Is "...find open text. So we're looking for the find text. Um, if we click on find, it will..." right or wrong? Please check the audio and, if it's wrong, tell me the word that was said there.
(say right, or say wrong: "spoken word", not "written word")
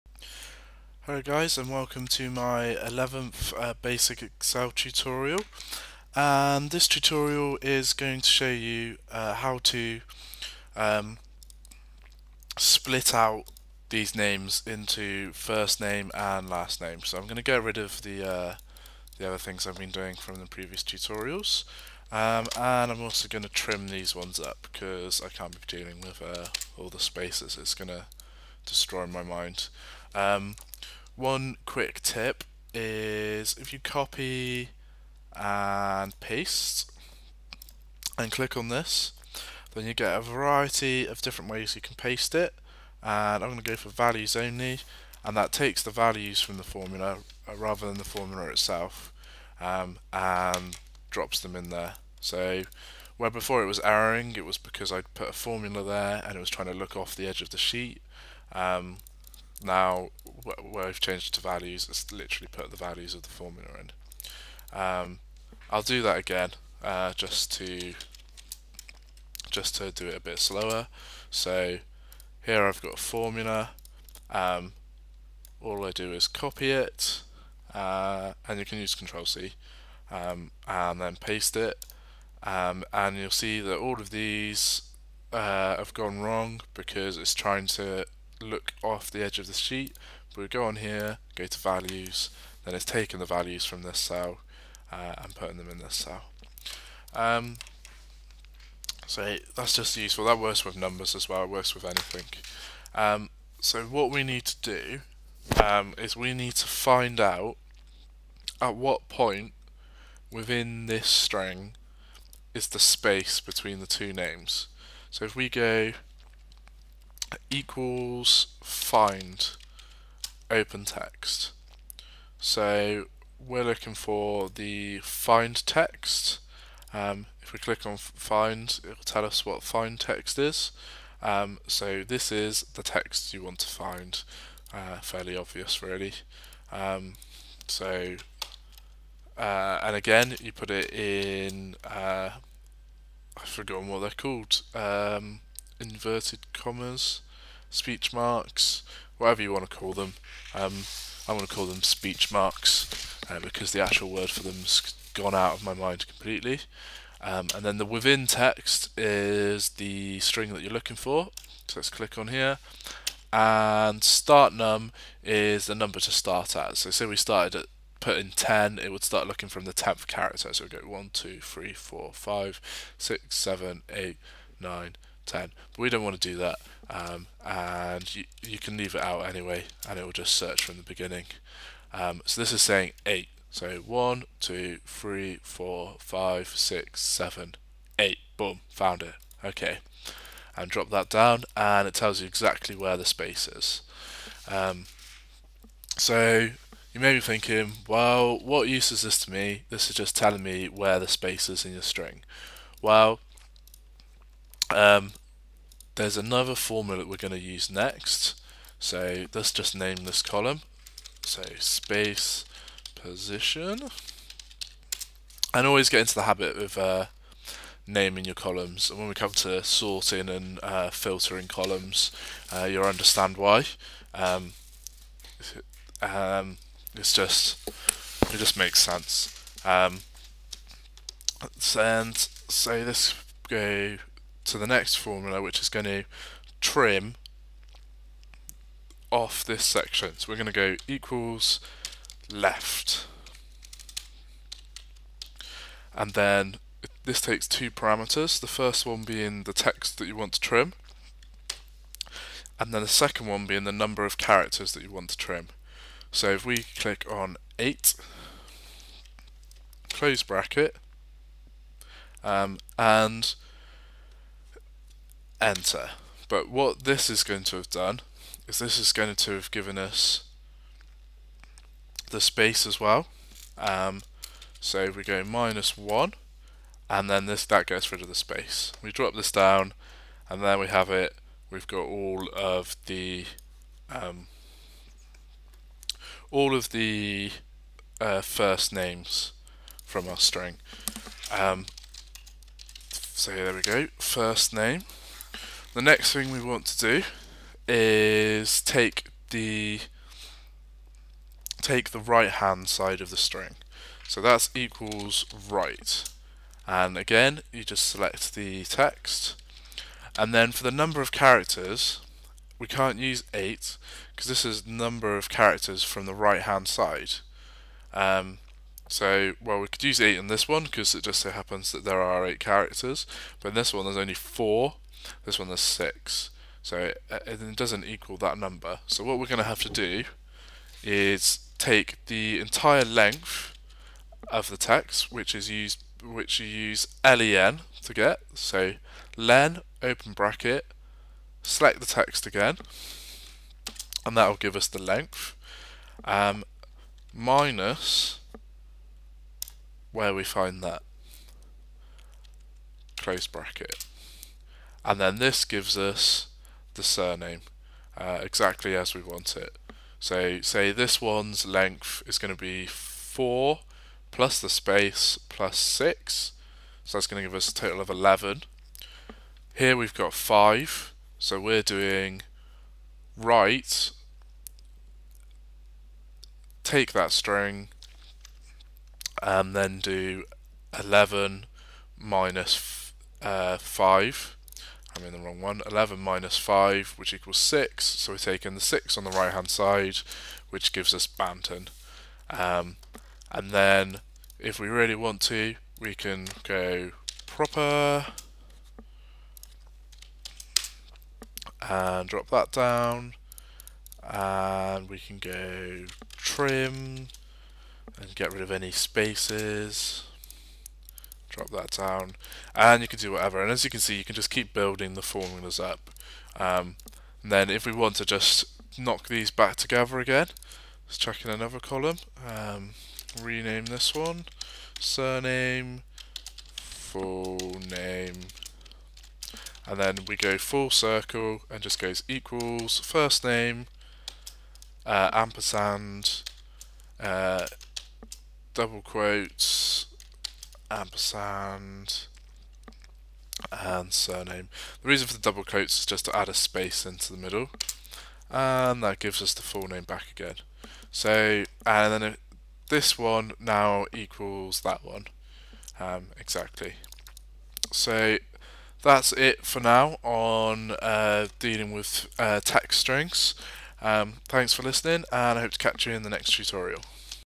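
right.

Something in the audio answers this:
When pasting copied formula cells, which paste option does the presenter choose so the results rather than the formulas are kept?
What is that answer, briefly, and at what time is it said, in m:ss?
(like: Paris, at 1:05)
values only, at 0:43.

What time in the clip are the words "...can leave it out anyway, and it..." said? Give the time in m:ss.
2:58.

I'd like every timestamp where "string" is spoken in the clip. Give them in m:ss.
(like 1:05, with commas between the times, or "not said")
1:51, 2:40, 3:21, 4:50, 5:03, 6:17, 7:42.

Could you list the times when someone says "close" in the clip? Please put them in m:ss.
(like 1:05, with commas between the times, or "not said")
4:19, 5:52.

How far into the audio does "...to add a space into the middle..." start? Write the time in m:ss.
7:26.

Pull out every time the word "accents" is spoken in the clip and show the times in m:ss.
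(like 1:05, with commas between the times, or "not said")
not said.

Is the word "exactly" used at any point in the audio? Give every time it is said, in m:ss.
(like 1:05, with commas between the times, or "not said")
3:12, 5:58, 7:36.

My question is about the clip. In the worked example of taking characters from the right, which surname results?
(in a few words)
Banton.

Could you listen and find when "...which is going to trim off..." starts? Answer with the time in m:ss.
3:55.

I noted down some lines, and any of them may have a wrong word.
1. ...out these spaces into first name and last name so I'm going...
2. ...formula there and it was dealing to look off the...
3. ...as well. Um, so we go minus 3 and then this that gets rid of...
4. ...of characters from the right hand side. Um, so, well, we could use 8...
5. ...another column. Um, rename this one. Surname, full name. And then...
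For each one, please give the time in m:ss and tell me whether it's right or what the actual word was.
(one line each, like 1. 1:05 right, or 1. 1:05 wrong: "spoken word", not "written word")
1. 0:13 wrong: "names", not "spaces"
2. 0:55 wrong: "trying", not "dealing"
3. 4:32 wrong: "1", not "3"
4. 5:15 right
5. 7:01 right.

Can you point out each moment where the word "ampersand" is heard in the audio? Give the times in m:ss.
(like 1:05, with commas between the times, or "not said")
7:15, 7:20.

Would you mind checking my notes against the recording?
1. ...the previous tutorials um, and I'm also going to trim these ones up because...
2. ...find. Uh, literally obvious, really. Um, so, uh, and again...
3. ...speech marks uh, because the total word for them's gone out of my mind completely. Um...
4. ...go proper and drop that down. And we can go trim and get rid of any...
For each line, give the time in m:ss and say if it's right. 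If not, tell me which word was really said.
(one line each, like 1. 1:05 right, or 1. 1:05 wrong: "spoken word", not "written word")
1. 0:20 right
2. 2:13 wrong: "fairly", not "literally"
3. 2:31 wrong: "actual", not "total"
4. 6:36 right.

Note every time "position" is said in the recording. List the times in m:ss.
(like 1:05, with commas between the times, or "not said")
3:32.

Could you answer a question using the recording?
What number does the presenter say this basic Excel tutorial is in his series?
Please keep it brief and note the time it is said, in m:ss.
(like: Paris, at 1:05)
11th, at 0:02.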